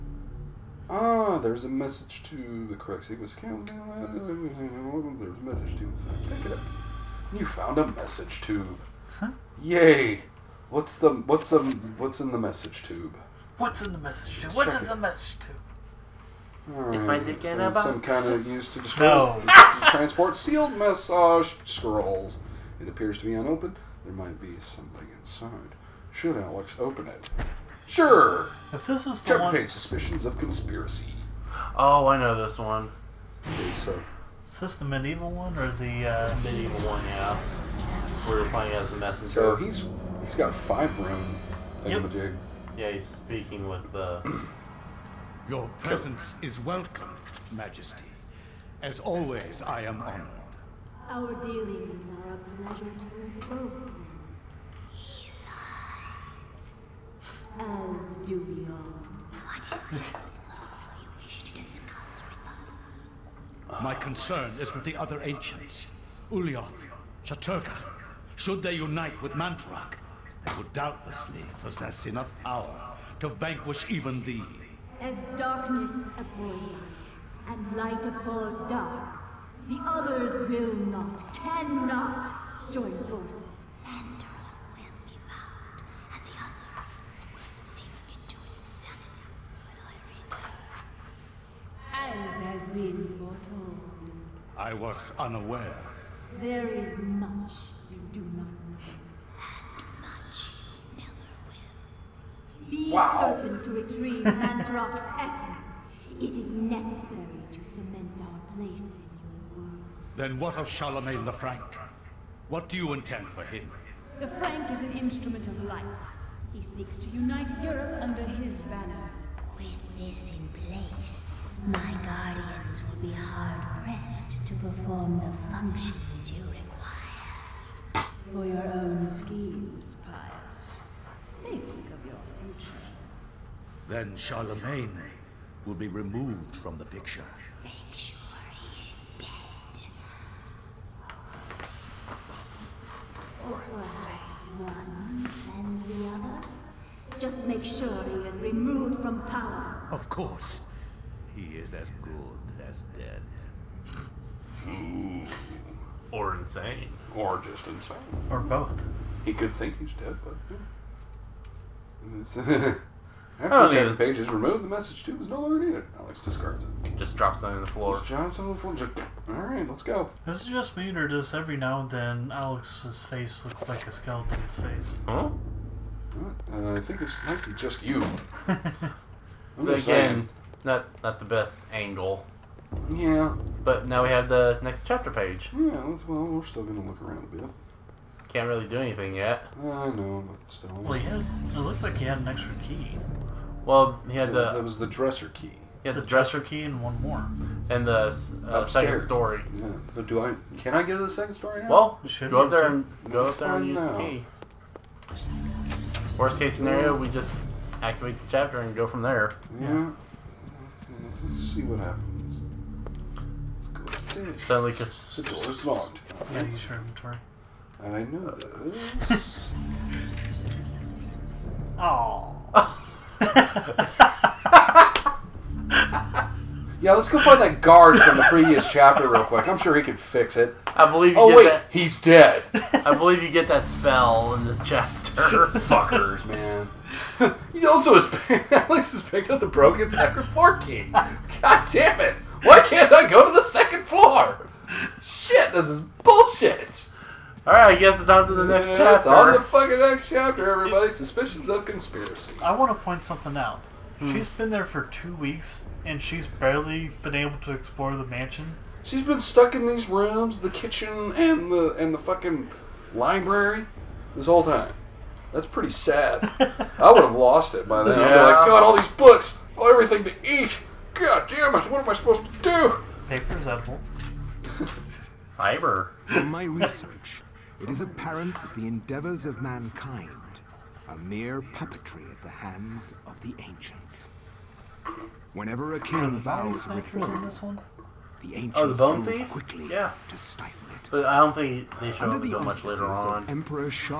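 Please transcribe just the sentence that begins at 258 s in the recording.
She's been stuck in these rooms, the kitchen, and the and the fucking library this whole time.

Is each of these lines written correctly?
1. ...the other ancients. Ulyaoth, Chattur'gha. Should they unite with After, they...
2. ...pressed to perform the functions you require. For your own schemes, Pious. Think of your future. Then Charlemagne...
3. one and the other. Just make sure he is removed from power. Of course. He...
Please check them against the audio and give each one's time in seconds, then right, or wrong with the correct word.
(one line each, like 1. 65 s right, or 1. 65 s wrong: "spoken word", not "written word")
1. 64 s wrong: "Mantorok", not "After"
2. 123 s right
3. 144 s right.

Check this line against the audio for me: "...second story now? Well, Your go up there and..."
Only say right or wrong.
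wrong.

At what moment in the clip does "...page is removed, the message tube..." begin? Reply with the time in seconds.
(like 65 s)
163 s.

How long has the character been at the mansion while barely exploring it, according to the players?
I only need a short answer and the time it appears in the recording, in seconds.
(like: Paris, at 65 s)
Two weeks, at 254 s.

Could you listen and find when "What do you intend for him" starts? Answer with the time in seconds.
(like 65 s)
112 s.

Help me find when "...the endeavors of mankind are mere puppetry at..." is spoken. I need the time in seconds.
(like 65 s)
278 s.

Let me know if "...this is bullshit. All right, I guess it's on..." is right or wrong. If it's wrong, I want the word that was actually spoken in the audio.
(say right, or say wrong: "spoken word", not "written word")
right.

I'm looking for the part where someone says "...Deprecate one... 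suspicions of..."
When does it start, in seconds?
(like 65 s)
29 s.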